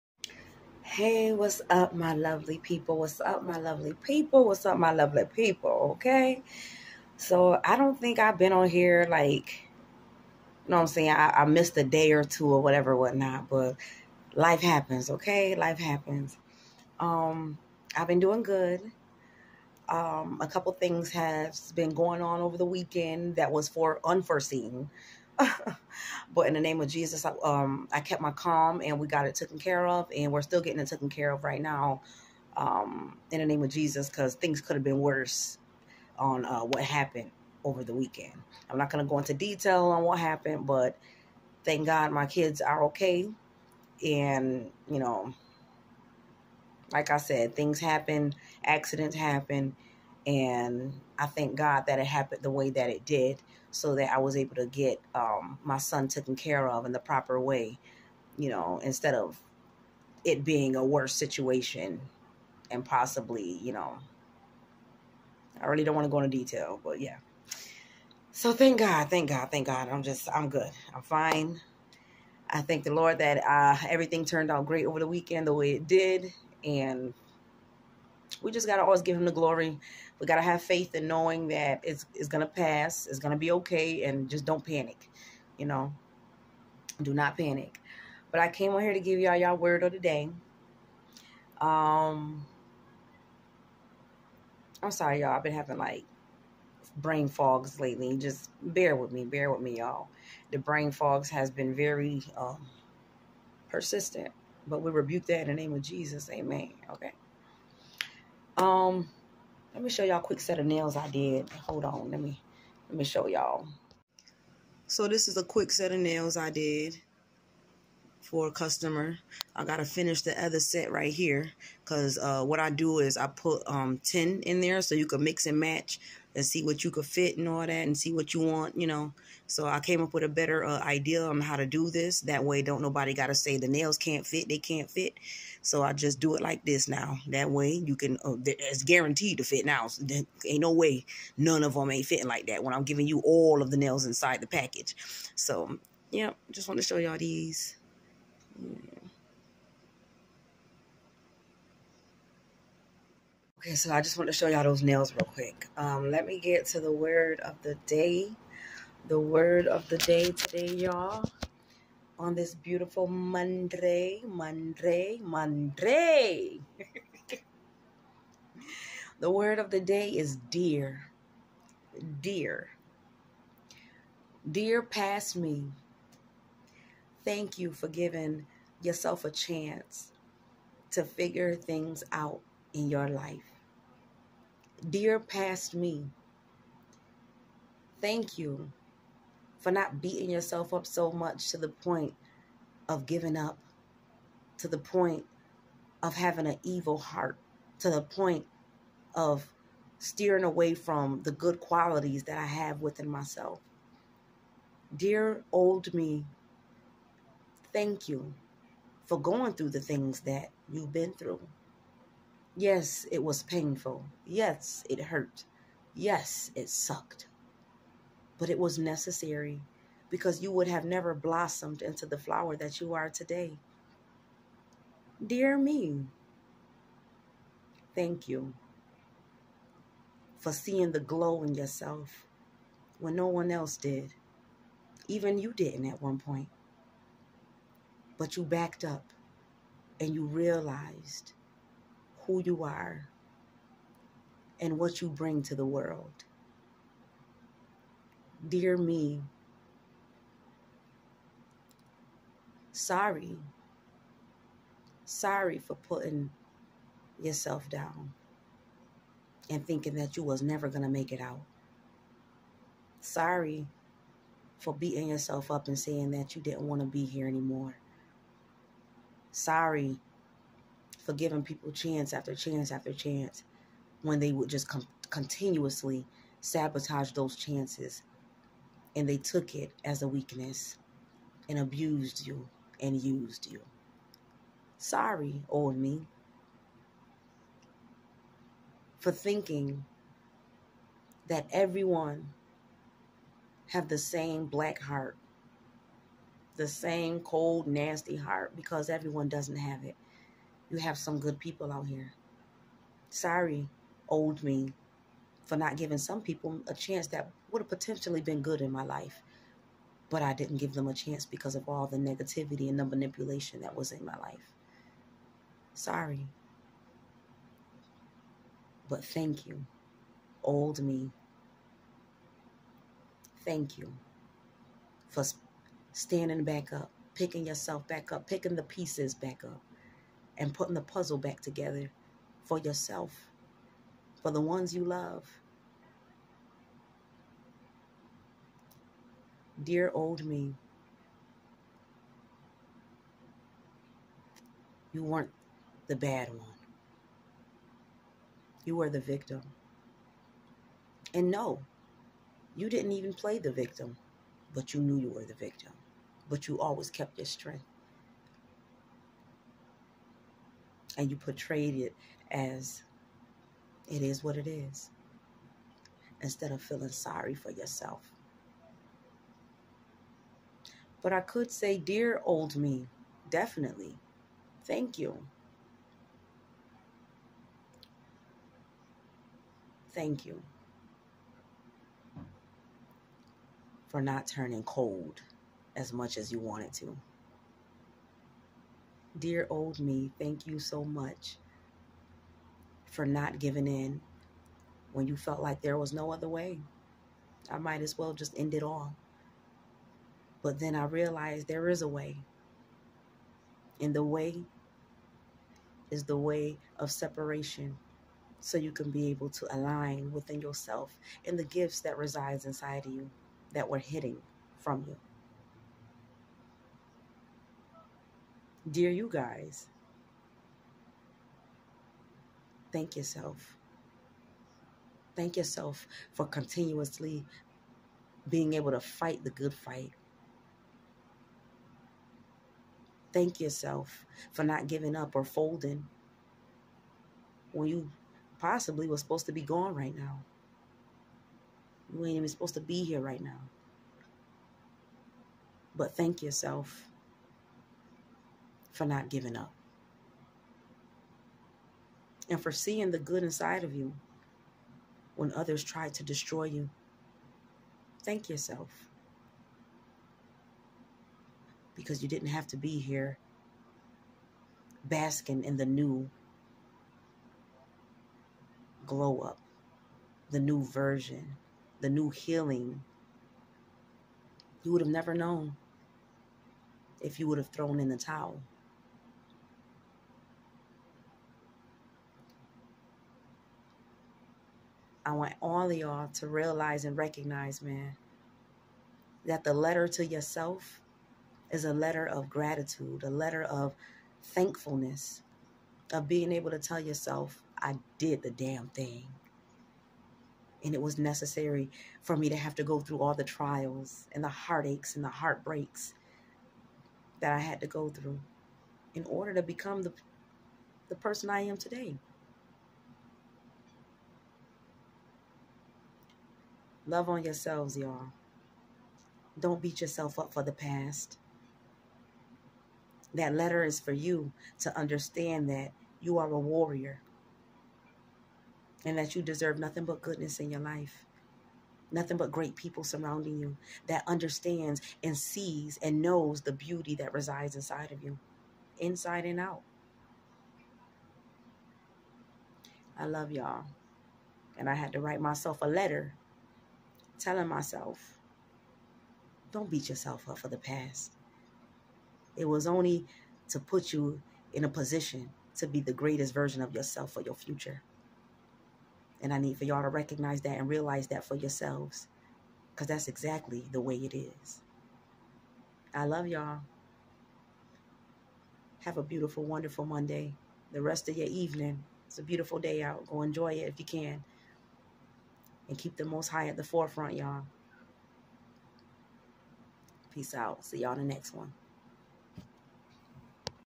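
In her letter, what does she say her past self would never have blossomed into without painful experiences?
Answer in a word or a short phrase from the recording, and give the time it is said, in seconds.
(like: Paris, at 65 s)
the flower, at 222 s.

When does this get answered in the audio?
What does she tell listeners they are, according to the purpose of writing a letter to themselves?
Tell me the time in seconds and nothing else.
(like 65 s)
526 s.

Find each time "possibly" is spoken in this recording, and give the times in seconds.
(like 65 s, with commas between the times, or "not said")
62 s, 438 s.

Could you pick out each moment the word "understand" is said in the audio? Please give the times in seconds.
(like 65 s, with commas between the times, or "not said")
524 s, 534 s.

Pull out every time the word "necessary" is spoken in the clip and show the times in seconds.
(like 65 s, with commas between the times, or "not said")
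218 s, 500 s.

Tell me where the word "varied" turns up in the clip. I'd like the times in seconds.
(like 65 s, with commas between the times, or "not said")
not said.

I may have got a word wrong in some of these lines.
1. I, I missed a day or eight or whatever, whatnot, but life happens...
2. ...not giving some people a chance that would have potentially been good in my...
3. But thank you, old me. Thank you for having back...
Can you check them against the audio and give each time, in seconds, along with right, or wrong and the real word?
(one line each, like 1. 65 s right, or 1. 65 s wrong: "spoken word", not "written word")
1. 11 s wrong: "two", not "eight"
2. 305 s right
3. 318 s wrong: "standing", not "having".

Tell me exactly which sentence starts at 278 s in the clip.
And they took it as a weakness and abused you and used you.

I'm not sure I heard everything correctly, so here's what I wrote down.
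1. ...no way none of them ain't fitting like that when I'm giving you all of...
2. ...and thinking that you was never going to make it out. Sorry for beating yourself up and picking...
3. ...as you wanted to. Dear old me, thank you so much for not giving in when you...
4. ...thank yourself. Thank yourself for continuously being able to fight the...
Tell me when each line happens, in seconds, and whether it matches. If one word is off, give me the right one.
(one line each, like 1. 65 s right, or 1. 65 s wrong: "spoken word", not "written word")
1. 140 s right
2. 259 s wrong: "saying", not "picking"
3. 386 s right
4. 422 s right.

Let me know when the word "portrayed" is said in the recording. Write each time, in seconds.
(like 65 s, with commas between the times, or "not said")
361 s.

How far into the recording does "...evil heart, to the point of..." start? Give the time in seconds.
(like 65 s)
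196 s.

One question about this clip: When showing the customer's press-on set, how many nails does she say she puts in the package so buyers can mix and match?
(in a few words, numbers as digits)
10.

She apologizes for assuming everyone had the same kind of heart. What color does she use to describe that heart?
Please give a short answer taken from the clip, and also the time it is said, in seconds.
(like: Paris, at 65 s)
black, at 294 s.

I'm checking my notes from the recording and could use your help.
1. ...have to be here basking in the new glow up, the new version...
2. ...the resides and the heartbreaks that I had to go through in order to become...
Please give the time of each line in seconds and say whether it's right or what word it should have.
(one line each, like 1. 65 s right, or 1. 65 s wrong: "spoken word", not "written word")
1. 462 s right
2. 504 s wrong: "heartaches", not "resides".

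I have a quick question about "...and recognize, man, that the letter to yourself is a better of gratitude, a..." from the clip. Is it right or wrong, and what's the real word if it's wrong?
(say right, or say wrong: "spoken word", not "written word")
wrong: "letter", not "better".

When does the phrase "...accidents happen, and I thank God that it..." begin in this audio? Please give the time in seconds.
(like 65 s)
48 s.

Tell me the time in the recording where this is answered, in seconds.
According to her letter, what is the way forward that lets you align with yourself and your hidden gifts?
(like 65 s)
406 s.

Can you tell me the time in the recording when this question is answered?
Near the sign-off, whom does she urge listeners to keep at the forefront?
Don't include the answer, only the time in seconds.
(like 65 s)
575 s.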